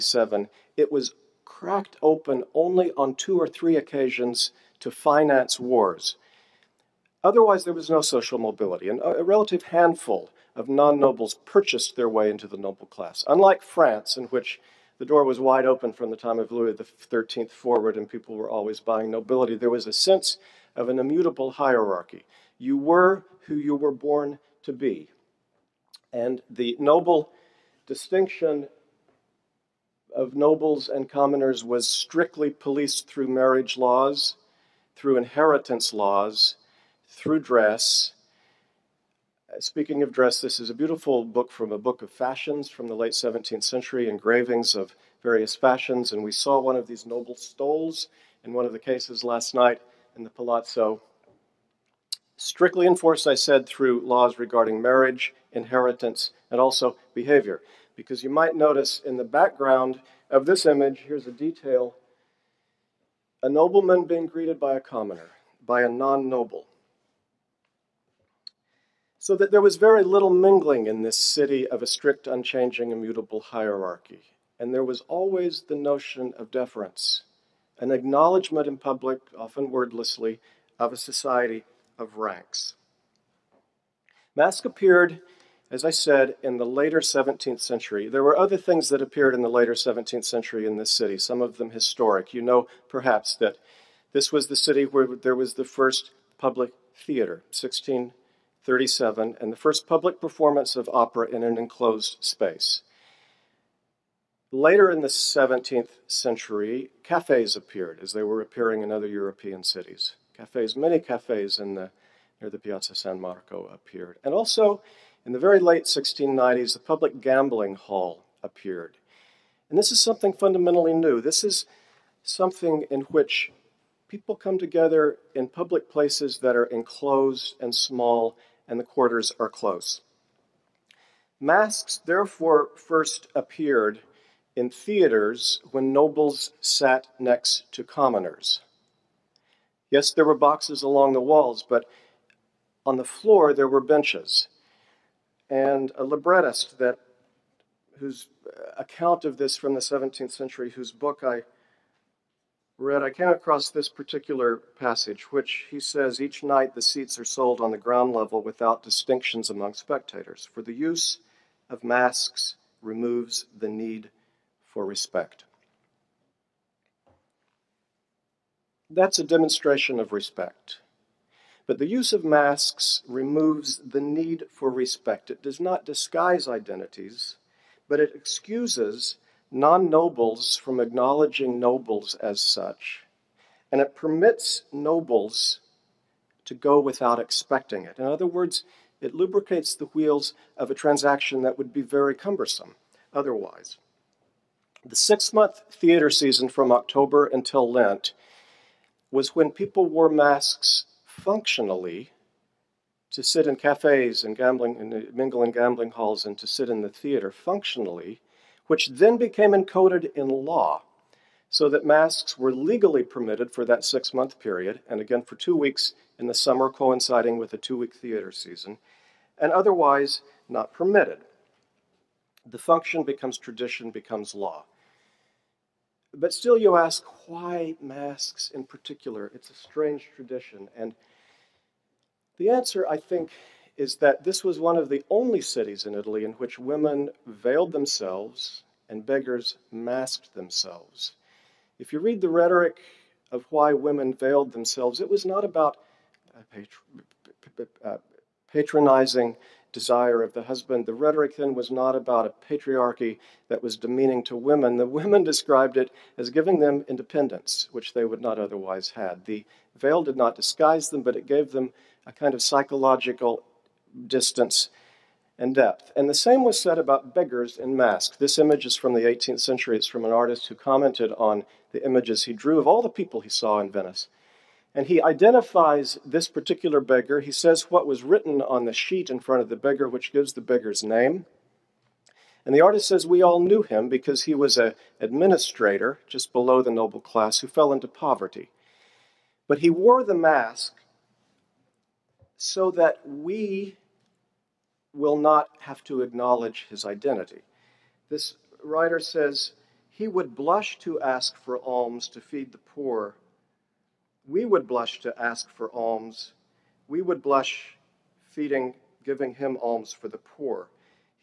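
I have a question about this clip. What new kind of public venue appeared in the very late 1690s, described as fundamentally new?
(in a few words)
public gambling hall.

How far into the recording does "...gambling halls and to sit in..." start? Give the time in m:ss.
3:25.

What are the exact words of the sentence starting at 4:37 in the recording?
He says what was written on the sheet in front of the beggar, which gives the beggar's name.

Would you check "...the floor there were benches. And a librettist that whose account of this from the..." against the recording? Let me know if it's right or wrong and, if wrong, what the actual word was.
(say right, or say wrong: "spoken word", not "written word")
right.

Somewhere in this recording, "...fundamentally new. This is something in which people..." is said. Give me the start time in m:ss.
2:00.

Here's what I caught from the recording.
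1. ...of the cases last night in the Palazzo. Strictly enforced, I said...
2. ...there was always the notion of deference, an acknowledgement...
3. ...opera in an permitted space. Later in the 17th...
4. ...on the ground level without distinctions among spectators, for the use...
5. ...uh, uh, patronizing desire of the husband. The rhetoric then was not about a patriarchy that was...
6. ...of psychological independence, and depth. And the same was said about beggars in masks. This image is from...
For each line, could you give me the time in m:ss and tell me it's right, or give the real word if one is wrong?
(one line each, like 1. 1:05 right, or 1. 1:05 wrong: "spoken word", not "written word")
1. 0:48 right
2. 1:14 right
3. 1:40 wrong: "enclosed", not "permitted"
4. 2:37 right
5. 4:06 right
6. 4:22 wrong: "distance", not "independence".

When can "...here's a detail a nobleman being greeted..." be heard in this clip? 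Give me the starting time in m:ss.
1:01.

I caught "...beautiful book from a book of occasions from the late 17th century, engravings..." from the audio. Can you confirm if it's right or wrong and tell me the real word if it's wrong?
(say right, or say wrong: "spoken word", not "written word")
wrong: "fashions", not "occasions".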